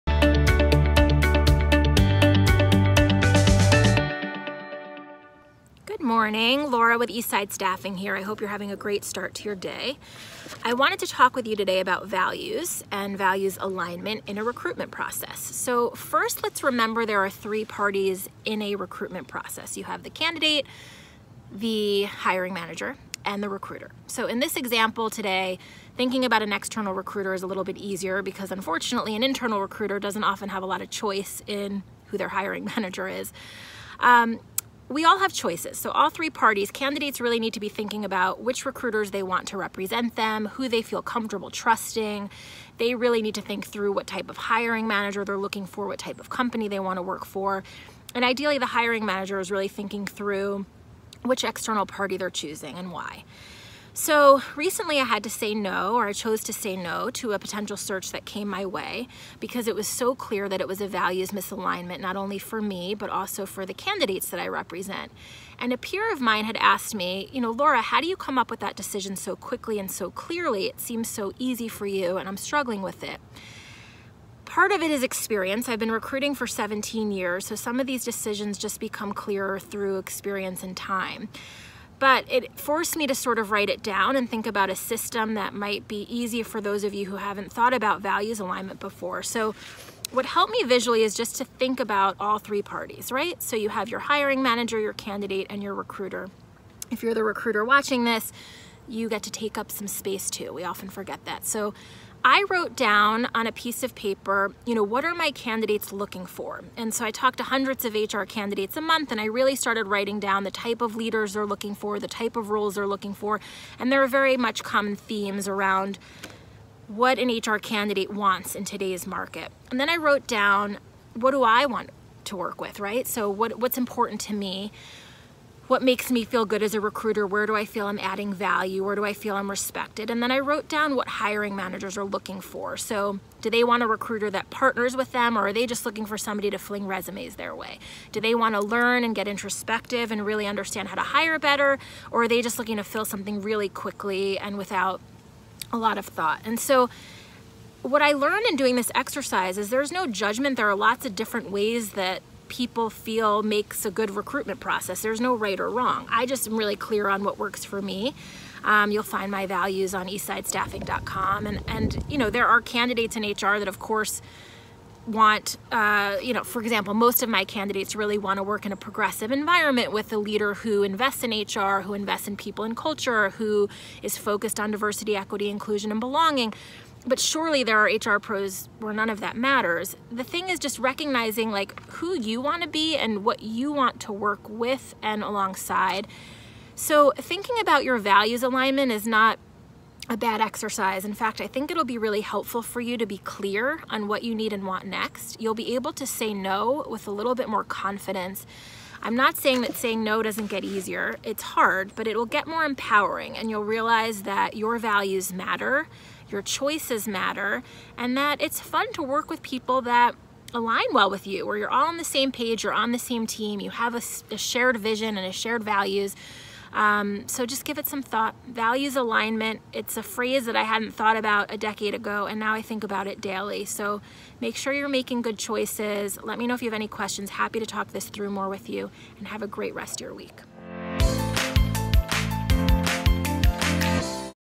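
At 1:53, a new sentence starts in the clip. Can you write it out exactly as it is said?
And there are very much common themes around what an HR candidate wants in today's market.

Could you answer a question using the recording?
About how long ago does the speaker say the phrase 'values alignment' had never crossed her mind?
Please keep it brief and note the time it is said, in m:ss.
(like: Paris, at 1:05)
A decade, at 3:41.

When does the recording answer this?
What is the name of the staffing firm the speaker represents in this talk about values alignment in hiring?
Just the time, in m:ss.
0:07.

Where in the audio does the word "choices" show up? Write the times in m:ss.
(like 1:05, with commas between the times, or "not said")
0:30, 0:35, 3:26, 3:45.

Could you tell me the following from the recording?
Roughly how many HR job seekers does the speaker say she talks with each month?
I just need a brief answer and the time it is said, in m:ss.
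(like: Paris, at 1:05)
Hundreds, at 1:47.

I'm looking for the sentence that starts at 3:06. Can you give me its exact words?
So thinking about your values alignment is not a bad exercise.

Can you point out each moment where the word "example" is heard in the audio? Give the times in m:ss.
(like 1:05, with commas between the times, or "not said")
0:24, 2:46.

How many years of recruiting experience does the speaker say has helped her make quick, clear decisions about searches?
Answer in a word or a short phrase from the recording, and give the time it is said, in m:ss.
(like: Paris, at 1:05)
17, at 1:16.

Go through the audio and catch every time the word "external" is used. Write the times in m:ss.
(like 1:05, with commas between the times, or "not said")
0:26, 0:51.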